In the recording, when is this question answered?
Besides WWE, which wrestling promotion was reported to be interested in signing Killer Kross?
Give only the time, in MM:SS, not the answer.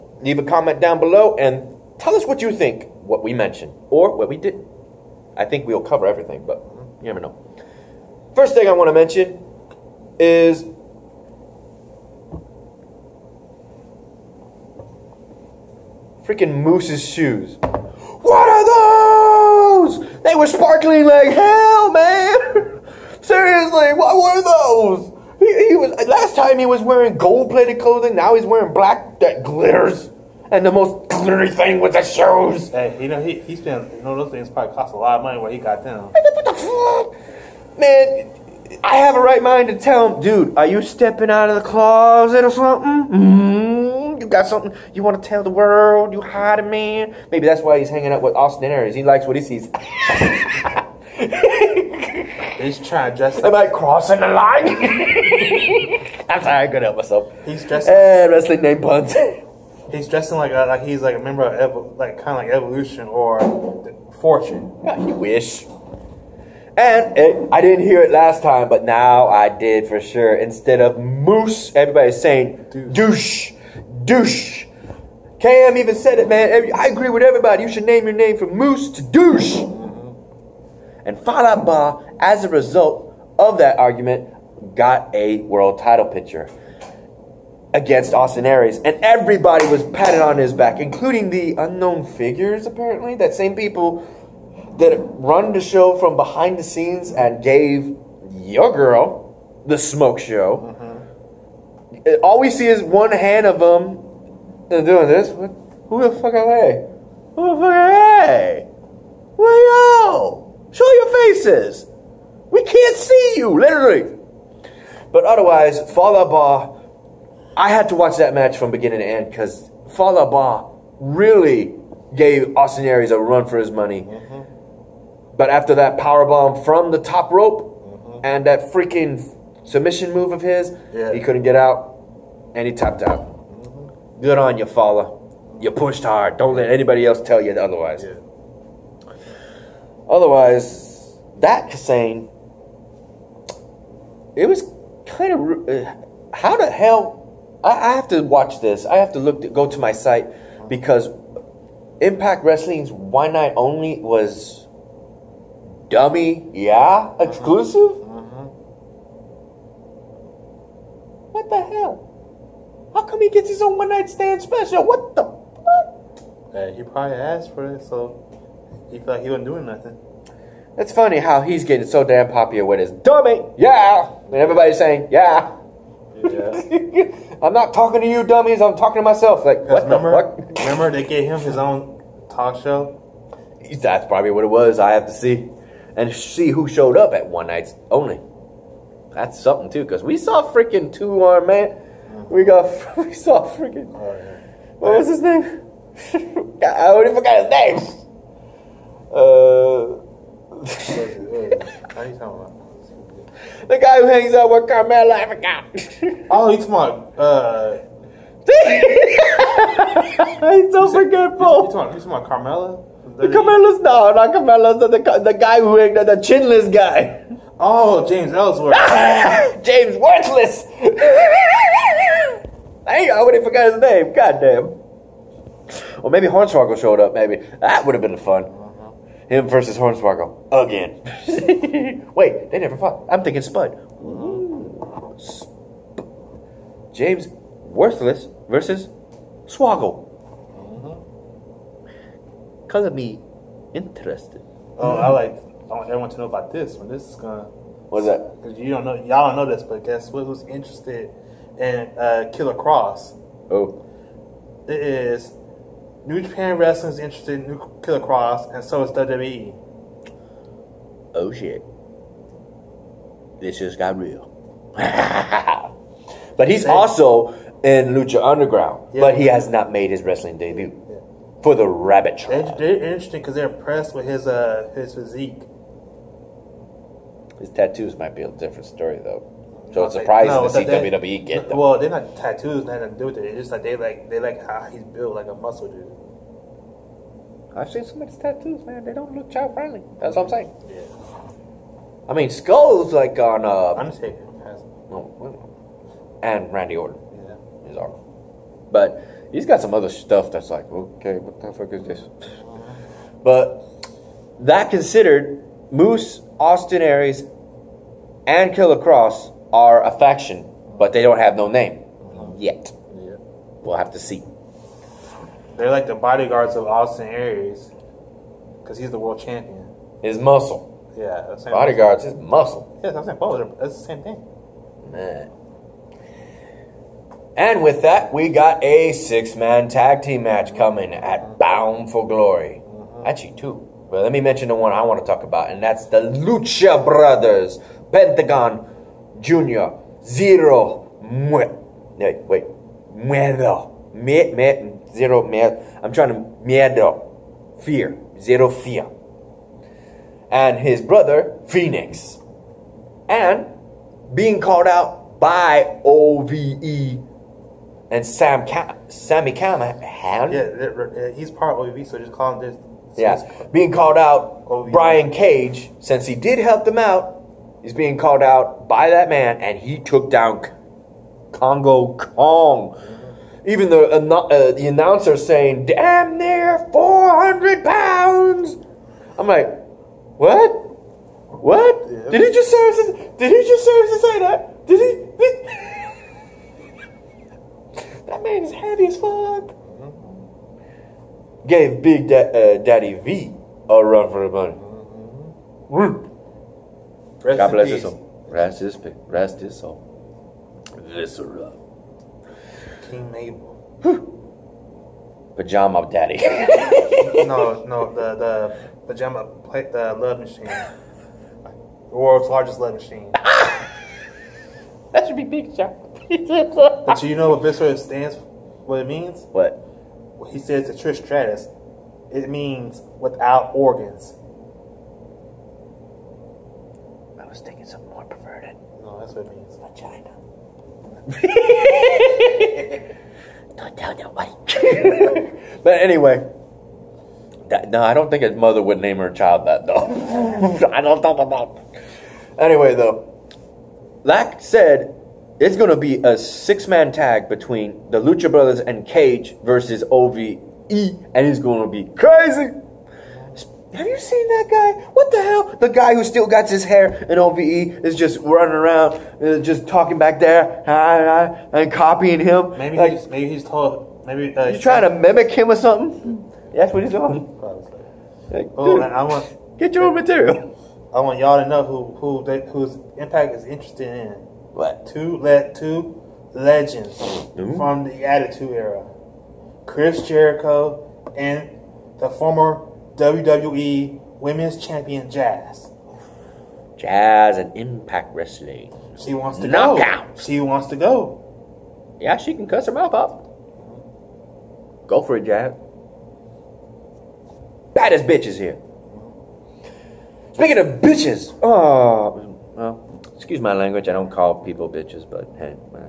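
04:16.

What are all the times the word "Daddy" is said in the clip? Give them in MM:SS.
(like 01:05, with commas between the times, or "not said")
06:32, 06:45.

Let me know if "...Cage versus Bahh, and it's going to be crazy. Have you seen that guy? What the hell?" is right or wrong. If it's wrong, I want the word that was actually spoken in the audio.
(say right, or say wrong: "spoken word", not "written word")
wrong: "OVE", not "Bahh".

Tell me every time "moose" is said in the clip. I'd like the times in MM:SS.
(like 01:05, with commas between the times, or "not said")
00:16, 01:10, 01:18, 05:05.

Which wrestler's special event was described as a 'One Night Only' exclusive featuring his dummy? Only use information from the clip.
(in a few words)
Kassane.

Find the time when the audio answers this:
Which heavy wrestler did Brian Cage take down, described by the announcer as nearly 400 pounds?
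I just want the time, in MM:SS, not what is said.
06:11.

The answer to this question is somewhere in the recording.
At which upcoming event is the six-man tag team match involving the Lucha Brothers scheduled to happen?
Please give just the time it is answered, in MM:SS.
05:31.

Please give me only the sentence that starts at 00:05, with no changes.
I think we'll cover everything, but mm, you never know.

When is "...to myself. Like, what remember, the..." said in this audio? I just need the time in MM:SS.
02:58.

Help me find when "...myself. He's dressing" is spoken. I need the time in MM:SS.
00:56.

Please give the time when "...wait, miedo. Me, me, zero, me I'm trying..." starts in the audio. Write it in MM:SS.
05:42.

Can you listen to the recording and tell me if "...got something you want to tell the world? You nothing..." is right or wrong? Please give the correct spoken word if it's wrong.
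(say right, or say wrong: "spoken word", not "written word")
wrong: "hiding", not "nothing".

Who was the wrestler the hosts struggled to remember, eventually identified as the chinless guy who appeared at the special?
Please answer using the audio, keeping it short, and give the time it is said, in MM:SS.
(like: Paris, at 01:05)
James Ellsworth, at 03:38.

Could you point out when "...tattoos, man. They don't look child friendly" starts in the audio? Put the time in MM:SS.
04:48.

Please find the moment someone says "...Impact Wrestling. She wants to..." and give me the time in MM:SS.
08:07.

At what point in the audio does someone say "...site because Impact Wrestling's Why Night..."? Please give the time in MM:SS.
02:29.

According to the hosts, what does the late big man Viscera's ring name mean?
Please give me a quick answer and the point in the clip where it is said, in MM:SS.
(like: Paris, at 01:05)
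Without organs, at 07:02.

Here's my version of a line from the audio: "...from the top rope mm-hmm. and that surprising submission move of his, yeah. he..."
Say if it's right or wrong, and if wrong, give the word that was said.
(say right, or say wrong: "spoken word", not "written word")
wrong: "freaking", not "surprising".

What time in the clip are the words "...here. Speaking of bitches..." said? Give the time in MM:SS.
08:18.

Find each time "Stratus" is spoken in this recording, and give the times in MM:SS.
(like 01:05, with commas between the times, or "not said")
07:01.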